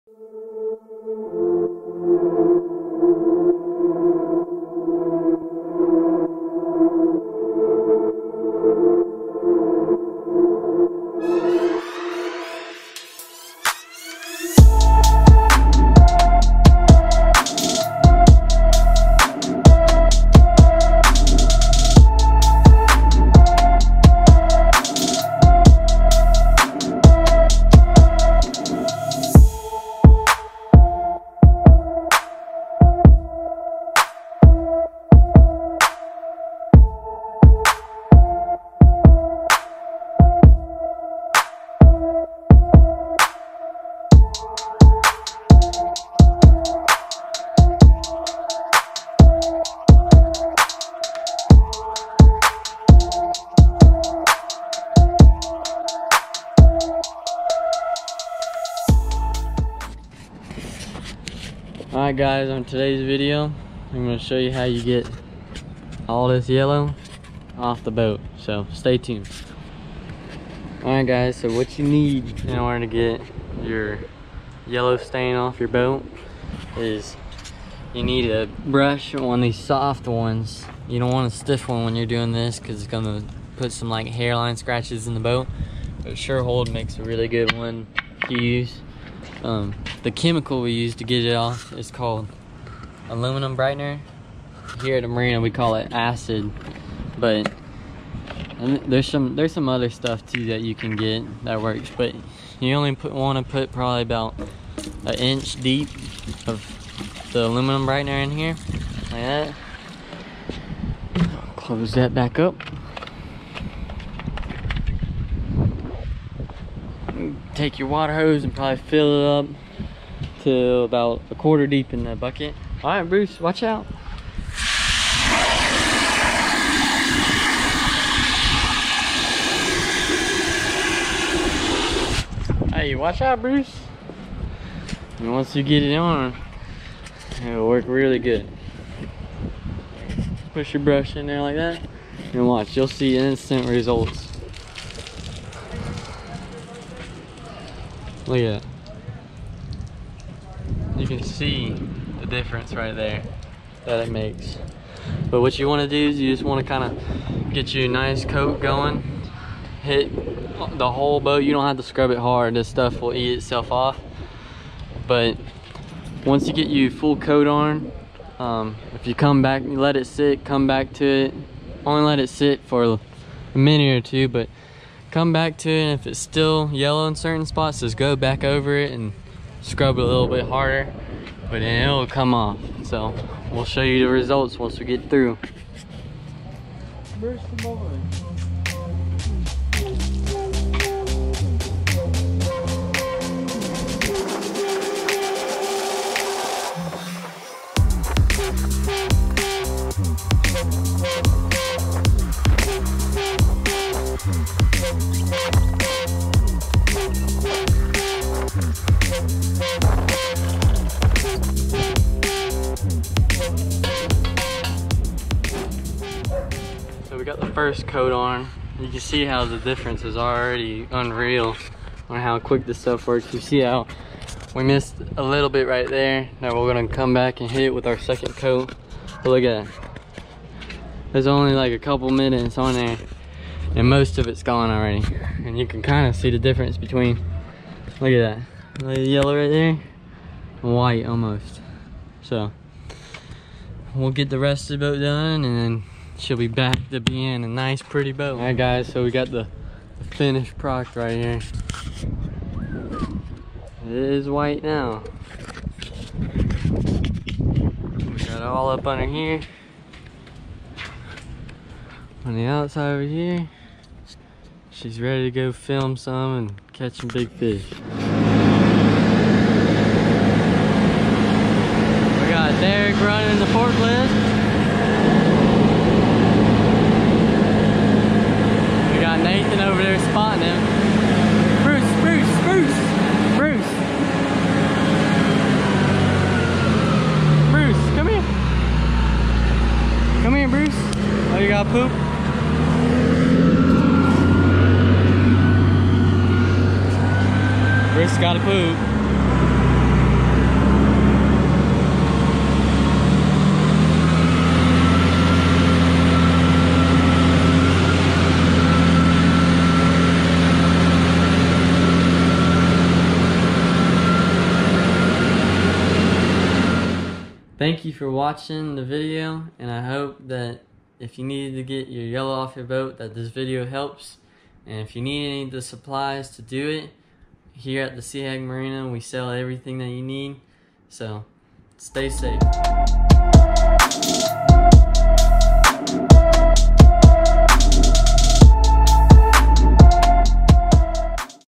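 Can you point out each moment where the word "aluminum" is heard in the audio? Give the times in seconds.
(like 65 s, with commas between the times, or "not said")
93 s, 107 s.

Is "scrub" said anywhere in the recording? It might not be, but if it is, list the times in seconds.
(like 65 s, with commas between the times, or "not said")
161 s, 179 s.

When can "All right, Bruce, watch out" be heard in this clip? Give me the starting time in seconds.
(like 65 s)
122 s.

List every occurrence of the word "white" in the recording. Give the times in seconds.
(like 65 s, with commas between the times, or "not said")
240 s, 254 s.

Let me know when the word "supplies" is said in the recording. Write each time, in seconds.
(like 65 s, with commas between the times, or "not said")
325 s.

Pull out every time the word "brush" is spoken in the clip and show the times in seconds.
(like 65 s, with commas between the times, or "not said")
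78 s, 140 s.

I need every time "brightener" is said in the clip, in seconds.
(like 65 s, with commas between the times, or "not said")
93 s, 107 s.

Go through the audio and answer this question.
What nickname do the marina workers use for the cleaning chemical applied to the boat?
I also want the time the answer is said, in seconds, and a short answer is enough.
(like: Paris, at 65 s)
acid, at 95 s.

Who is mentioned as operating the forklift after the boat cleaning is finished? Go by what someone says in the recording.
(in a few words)
Derek.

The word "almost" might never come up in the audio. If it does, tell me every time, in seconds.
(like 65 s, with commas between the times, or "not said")
241 s.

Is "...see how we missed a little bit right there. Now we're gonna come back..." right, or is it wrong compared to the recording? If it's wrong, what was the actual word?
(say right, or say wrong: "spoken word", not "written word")
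right.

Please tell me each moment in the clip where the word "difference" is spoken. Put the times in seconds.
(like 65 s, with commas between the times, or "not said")
152 s, 219 s, 236 s.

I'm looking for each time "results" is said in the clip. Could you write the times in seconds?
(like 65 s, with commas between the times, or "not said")
143 s, 184 s.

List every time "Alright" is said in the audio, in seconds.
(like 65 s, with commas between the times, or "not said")
62 s, 70 s.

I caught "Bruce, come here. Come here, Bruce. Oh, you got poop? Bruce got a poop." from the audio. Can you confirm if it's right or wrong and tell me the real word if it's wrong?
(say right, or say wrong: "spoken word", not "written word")
right.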